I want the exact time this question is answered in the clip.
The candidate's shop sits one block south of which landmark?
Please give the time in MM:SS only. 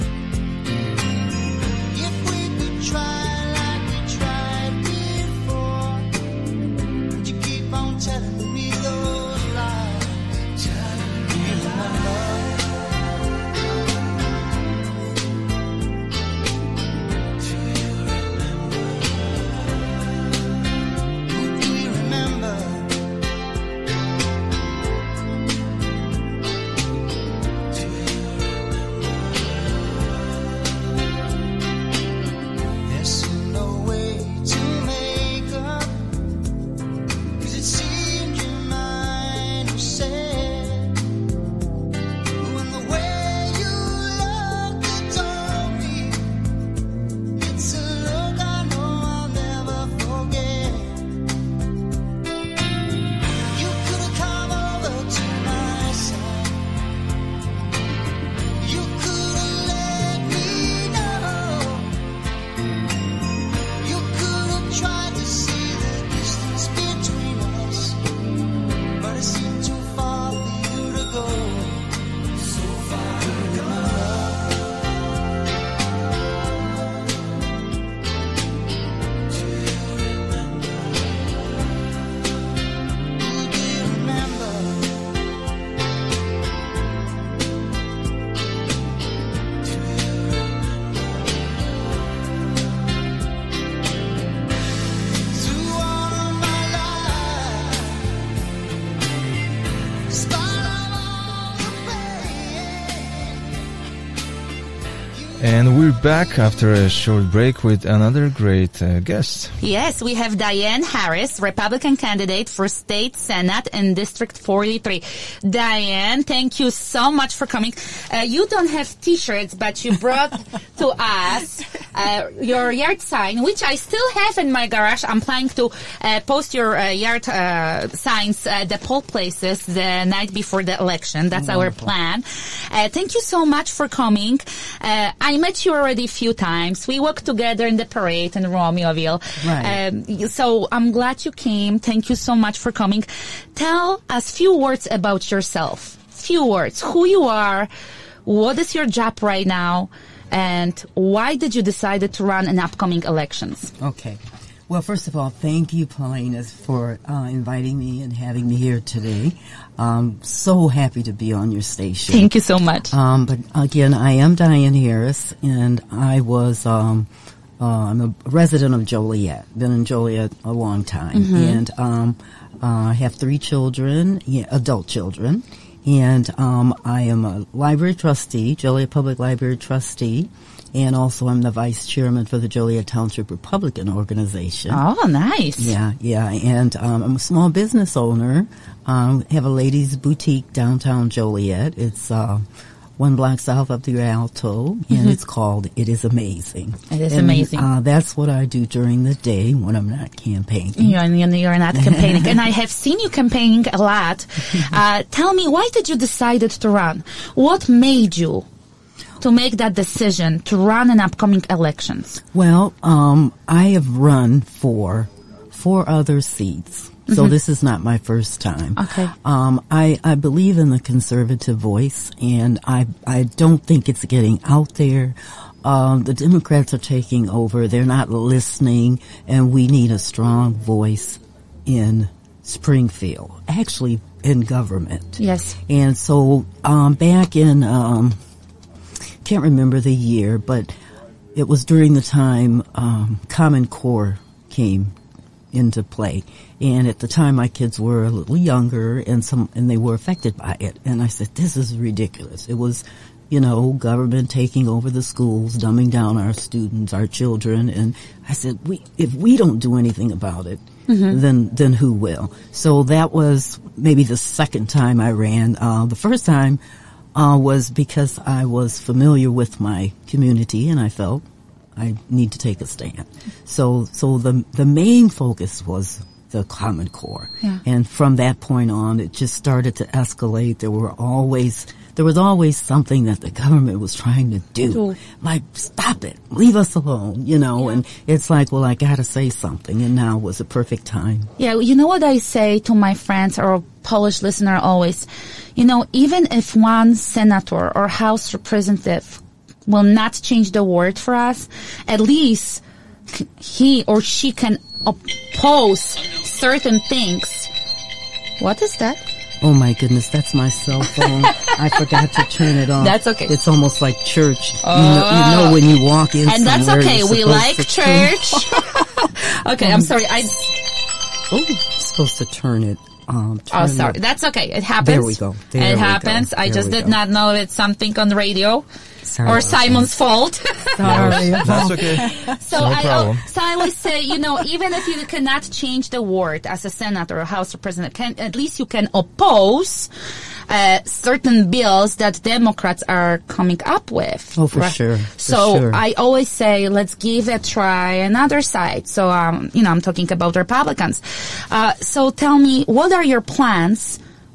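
03:13.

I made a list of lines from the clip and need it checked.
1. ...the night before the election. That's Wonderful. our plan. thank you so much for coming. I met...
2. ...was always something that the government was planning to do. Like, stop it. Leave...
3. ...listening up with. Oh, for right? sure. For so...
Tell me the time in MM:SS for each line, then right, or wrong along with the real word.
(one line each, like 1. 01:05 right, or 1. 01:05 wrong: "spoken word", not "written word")
1. 02:09 right
2. 04:42 wrong: "trying", not "planning"
3. 05:43 wrong: "coming", not "listening".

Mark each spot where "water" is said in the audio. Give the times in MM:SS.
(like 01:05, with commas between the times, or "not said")
not said.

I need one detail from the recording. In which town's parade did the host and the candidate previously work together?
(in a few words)
Romeoville.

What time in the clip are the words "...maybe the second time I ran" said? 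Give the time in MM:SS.
04:23.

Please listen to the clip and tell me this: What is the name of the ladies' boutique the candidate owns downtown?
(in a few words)
It Is Amazing.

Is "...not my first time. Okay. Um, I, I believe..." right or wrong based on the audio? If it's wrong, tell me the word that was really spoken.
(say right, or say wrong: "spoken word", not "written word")
right.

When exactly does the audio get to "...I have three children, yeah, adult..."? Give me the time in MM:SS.
02:52.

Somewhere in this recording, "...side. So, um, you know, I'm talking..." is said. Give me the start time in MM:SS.
05:48.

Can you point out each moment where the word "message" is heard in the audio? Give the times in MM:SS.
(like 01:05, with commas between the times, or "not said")
not said.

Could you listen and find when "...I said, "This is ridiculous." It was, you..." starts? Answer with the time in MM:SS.
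04:11.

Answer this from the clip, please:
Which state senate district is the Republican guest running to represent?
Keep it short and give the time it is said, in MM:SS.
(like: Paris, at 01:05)
District 43, at 01:53.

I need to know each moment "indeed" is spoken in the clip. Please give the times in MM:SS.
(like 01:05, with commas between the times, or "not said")
not said.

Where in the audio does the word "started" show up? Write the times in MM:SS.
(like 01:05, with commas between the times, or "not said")
04:39.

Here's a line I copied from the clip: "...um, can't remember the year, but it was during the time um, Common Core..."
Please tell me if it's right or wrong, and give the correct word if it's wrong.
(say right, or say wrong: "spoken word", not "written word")
right.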